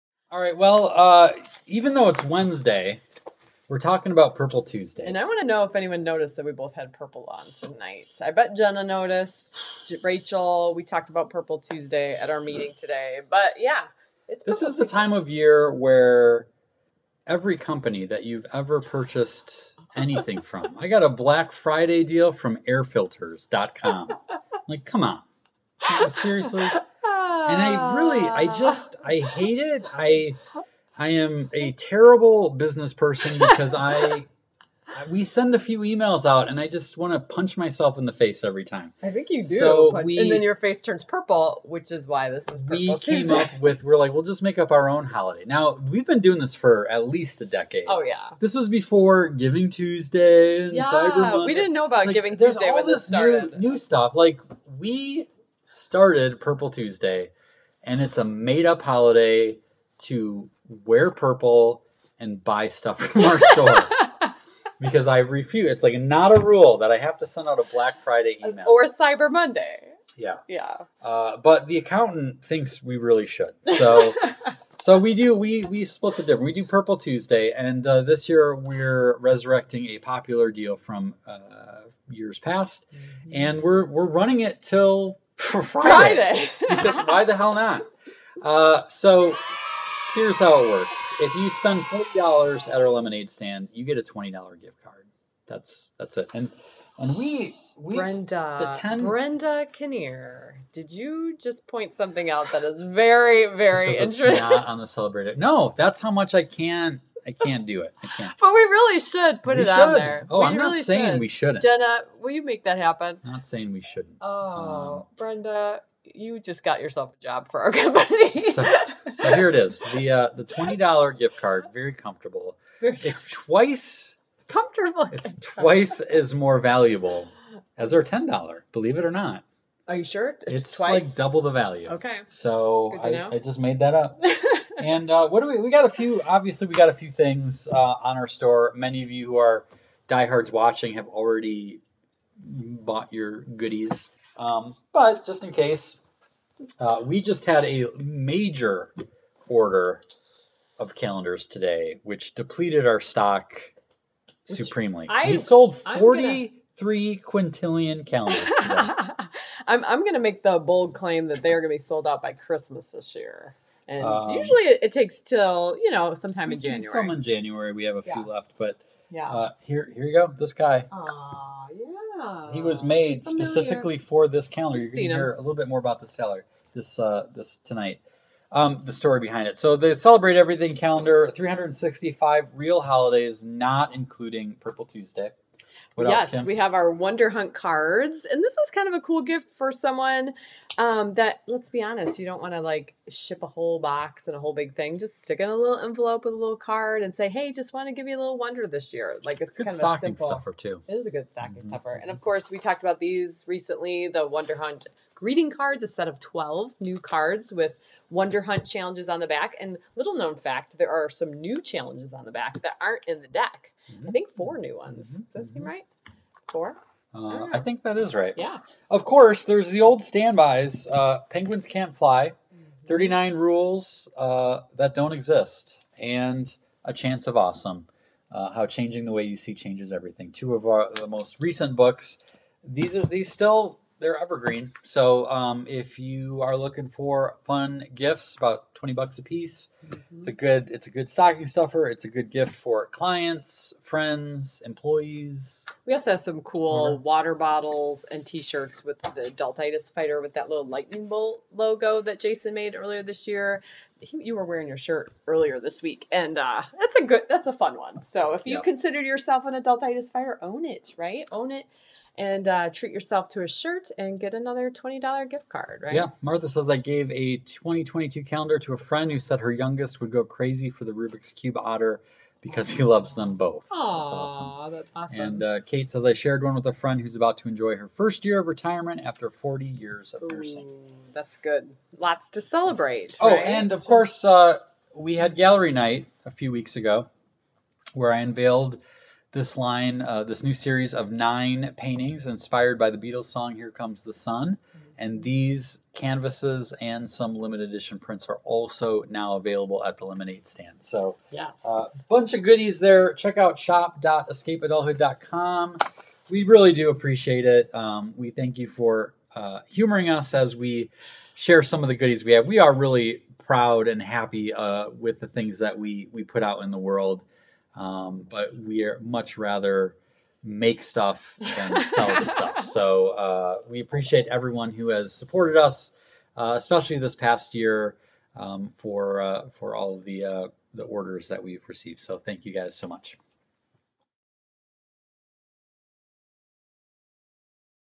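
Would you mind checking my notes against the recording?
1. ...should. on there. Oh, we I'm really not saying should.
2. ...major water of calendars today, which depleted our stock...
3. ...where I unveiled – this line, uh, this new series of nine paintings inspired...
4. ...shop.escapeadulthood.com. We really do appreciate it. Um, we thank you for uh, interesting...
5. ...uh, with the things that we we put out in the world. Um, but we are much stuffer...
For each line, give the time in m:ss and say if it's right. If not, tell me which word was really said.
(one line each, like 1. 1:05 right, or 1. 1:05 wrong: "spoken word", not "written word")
1. 1:49 right
2. 2:27 wrong: "order", not "water"
3. 4:47 right
4. 5:03 wrong: "humoring", not "interesting"
5. 5:14 wrong: "rather", not "stuffer".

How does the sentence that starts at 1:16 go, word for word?
We do Purple Tuesday, and uh, this year we're resurrecting a popular deal from uh, years past, mm-hmm.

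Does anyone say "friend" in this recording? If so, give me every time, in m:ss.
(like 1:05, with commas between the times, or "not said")
4:03, 4:28, 4:36.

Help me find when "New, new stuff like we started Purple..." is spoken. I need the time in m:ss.
0:53.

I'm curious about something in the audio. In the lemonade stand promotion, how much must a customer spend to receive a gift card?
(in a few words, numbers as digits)
$40.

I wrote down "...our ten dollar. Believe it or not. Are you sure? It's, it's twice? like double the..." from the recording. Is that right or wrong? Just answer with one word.
right.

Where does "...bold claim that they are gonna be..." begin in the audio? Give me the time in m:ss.
2:40.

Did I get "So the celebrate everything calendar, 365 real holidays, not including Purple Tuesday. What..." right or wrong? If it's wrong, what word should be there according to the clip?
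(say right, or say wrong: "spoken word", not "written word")
right.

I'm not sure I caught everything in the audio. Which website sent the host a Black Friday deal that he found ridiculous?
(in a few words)
airfilters.com.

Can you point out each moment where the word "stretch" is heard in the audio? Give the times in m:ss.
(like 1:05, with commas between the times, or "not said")
not said.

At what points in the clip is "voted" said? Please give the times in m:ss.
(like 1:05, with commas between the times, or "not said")
not said.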